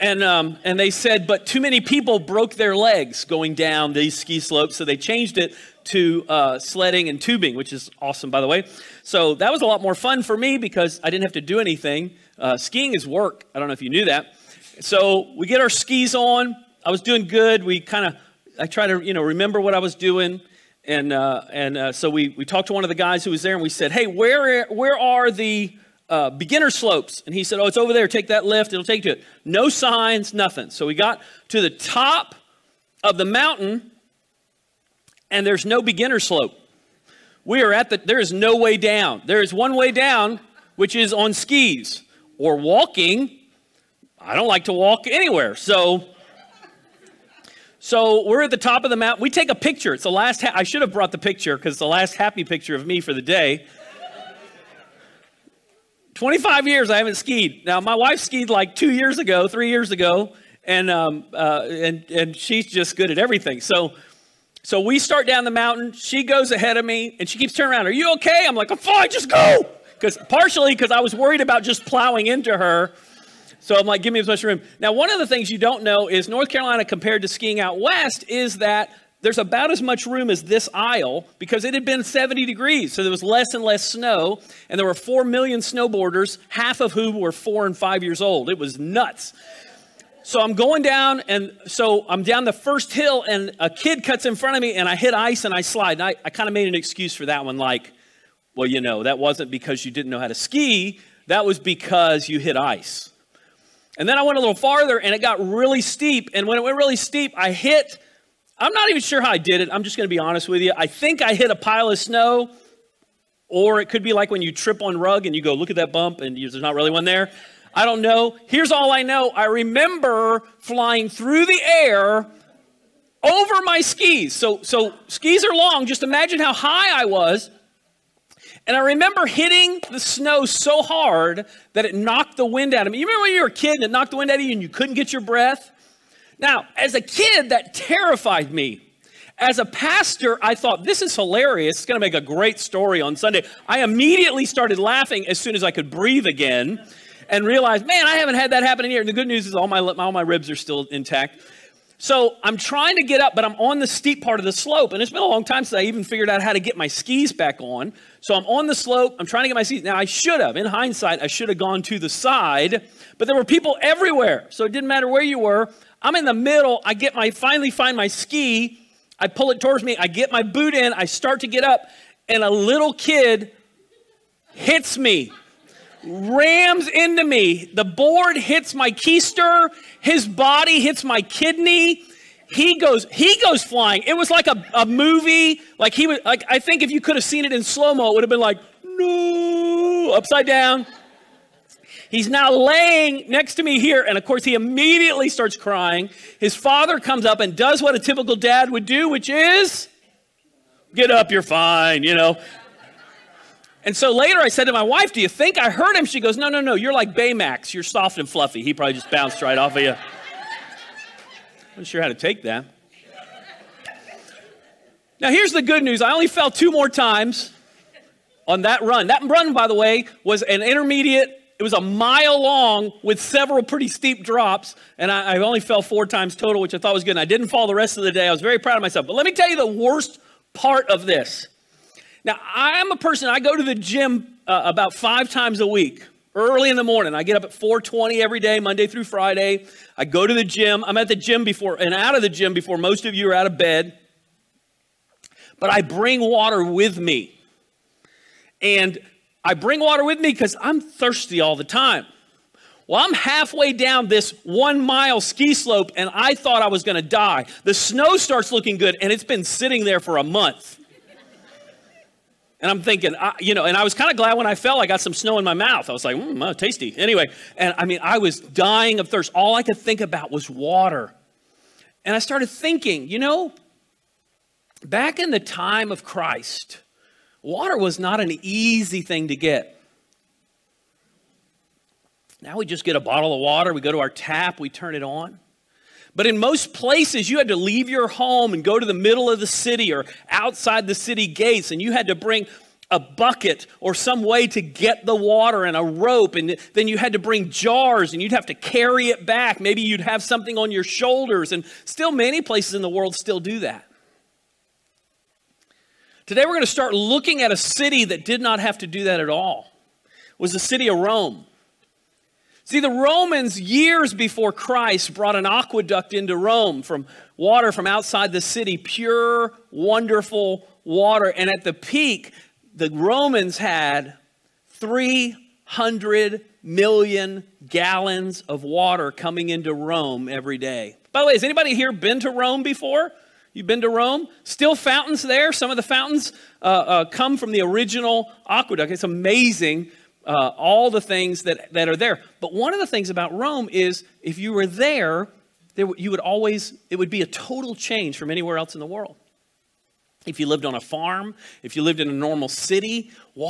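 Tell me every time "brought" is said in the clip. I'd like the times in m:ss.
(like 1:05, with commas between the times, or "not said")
0:50, 5:15.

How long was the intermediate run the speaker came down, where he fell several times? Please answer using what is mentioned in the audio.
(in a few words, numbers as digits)
a mile.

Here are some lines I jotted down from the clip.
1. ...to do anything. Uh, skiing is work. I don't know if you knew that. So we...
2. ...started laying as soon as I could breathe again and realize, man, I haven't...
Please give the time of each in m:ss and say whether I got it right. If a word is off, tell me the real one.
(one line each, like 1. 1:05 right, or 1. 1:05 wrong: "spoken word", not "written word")
1. 0:11 right
2. 2:24 wrong: "laughing", not "laying".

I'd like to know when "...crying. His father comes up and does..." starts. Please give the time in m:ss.
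3:15.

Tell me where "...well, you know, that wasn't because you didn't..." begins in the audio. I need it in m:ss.
1:38.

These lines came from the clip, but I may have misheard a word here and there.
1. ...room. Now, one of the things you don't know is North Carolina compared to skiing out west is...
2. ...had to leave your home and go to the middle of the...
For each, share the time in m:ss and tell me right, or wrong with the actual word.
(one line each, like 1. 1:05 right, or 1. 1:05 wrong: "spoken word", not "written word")
1. 1:14 right
2. 4:47 right.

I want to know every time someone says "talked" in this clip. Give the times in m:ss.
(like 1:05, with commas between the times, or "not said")
0:22.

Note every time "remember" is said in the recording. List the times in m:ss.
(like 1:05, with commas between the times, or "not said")
0:19, 1:59, 2:08, 2:13.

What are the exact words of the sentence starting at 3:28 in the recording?
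He probably just bounced right off of you.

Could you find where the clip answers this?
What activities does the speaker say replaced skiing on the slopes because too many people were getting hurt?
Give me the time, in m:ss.
0:06.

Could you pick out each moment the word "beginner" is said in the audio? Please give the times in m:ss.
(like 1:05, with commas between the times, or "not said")
0:26, 0:35.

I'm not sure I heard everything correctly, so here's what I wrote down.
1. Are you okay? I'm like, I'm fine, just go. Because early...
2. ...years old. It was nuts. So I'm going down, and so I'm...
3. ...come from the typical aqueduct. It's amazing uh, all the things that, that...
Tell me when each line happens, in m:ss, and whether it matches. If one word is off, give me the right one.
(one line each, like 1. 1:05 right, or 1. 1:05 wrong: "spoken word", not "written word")
1. 1:07 wrong: "partially", not "early"
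2. 1:28 right
3. 5:37 wrong: "original", not "typical".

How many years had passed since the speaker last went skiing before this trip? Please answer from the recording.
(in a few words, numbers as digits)
25.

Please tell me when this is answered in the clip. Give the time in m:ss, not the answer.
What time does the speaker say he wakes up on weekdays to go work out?
3:57.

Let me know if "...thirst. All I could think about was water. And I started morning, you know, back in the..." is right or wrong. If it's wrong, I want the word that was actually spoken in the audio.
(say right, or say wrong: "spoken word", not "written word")
wrong: "thinking", not "morning".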